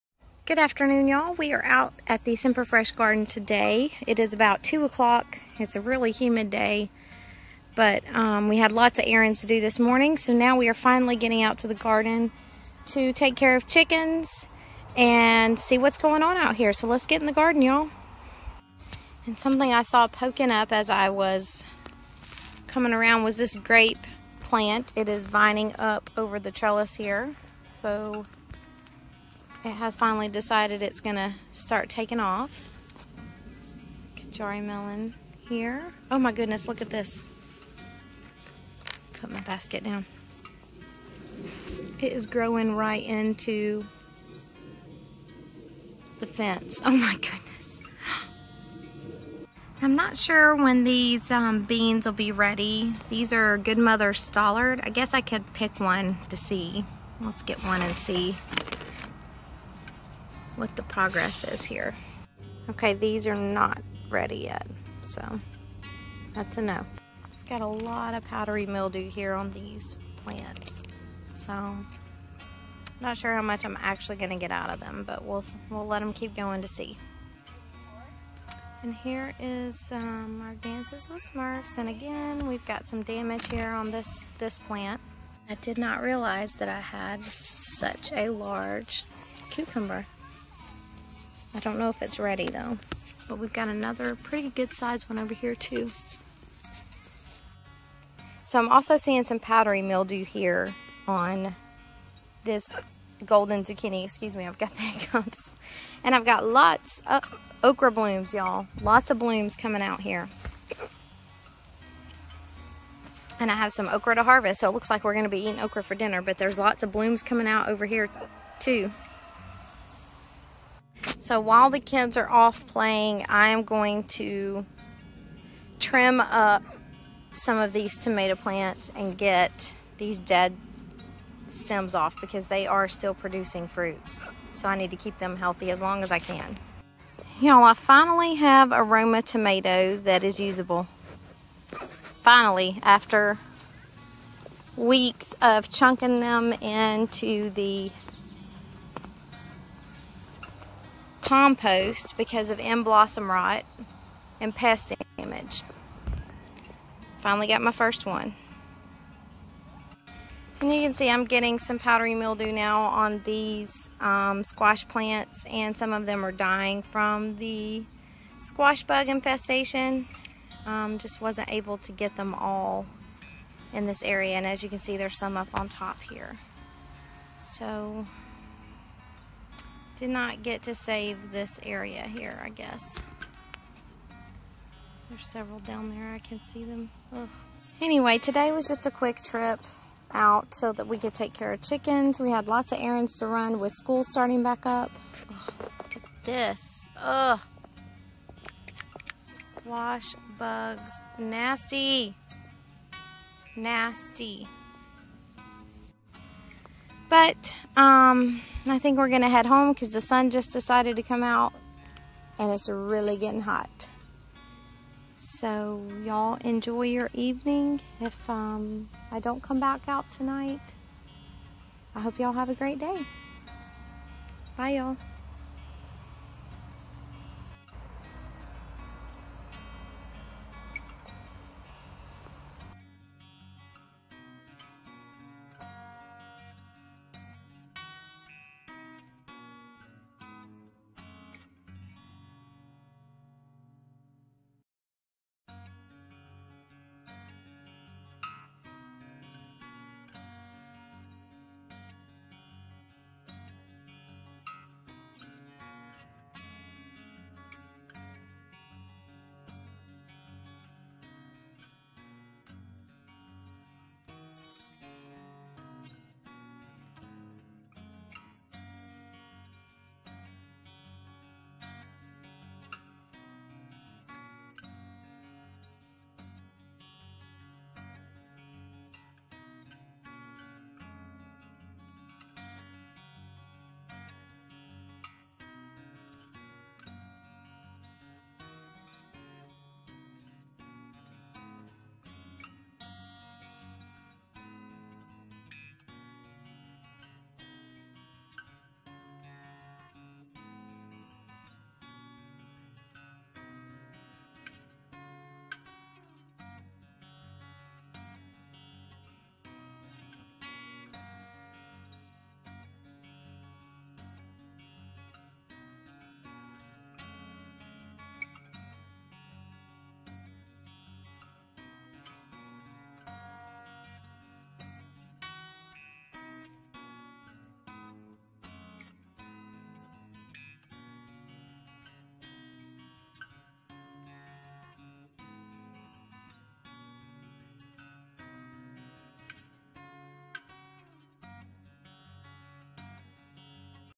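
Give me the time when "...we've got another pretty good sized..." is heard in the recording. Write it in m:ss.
1:33.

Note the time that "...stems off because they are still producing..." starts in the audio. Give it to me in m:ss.
2:11.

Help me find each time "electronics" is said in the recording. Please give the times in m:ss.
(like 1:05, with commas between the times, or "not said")
not said.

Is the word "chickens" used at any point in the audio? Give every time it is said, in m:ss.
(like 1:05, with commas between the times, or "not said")
0:13, 3:11.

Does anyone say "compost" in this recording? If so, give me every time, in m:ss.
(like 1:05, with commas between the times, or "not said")
2:31.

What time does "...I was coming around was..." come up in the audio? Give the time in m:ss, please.
0:20.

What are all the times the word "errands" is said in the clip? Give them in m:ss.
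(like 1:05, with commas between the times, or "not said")
0:09, 3:12.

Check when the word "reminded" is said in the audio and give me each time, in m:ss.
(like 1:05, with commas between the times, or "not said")
not said.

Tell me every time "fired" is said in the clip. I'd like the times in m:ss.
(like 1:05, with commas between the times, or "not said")
not said.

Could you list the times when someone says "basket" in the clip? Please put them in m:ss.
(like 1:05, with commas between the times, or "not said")
0:39.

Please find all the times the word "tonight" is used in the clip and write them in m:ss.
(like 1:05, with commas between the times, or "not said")
3:40.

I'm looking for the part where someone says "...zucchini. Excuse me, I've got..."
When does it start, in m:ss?
1:43.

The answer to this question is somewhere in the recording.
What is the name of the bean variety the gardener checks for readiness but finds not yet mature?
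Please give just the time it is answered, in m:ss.
0:53.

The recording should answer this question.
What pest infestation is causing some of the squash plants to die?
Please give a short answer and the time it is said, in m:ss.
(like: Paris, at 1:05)
Squash bugs, at 2:48.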